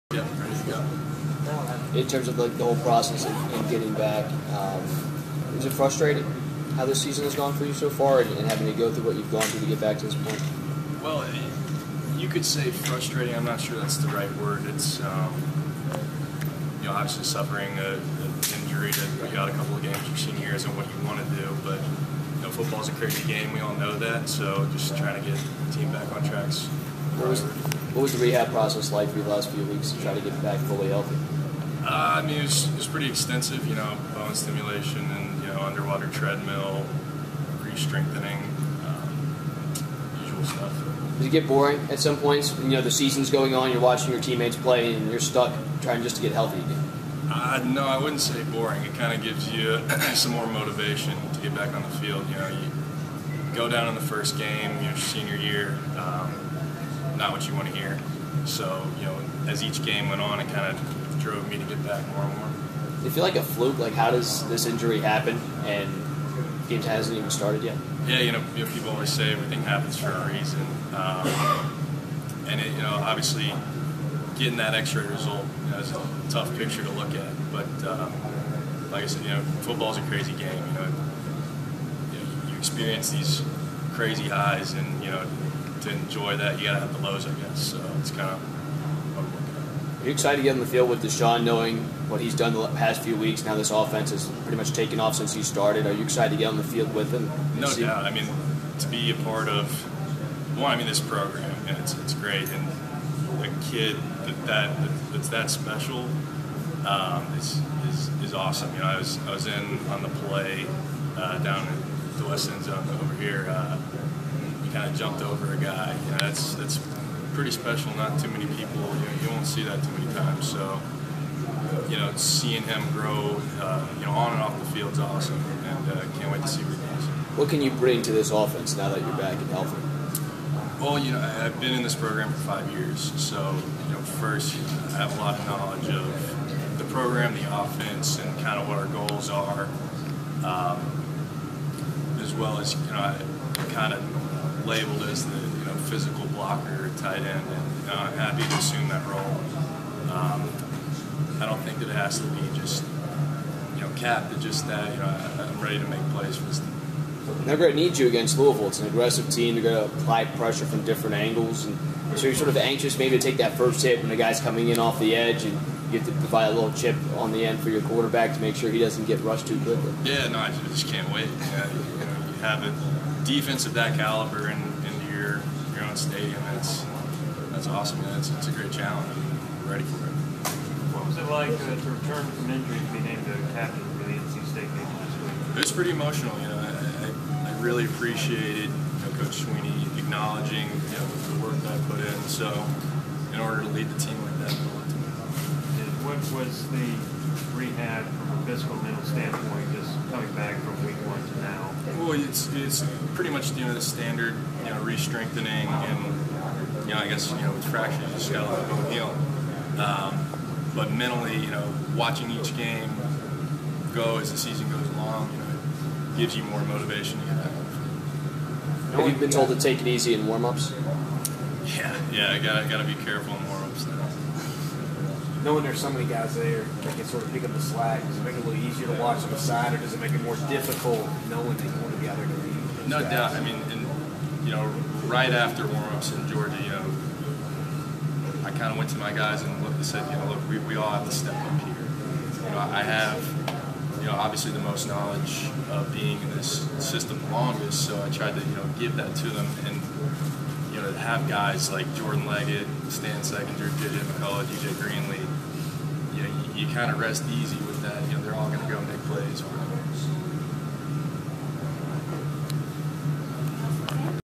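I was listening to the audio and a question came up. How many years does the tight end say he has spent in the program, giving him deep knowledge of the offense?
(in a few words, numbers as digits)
5.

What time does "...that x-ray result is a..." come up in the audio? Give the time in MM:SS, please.
01:14.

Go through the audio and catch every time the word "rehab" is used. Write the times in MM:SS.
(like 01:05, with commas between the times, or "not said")
00:28, 03:17.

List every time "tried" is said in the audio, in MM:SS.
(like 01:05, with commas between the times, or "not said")
04:08.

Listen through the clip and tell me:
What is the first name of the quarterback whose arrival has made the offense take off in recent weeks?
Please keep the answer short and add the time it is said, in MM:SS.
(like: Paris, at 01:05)
Deshaun, at 01:31.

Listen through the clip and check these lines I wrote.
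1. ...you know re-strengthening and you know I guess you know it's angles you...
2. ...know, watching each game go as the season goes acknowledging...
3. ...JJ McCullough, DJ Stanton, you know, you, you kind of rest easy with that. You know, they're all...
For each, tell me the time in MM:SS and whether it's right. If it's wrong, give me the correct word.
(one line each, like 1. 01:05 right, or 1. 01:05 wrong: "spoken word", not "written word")
1. 03:24 wrong: "fractures", not "angles"
2. 03:31 wrong: "along", not "acknowledging"
3. 04:13 wrong: "Greenlee", not "Stanton".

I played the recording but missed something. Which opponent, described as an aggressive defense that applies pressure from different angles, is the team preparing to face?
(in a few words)
Louisville.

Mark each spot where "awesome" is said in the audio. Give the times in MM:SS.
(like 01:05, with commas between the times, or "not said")
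01:48, 02:04, 02:57.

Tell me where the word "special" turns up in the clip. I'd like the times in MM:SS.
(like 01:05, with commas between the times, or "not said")
01:45, 01:57.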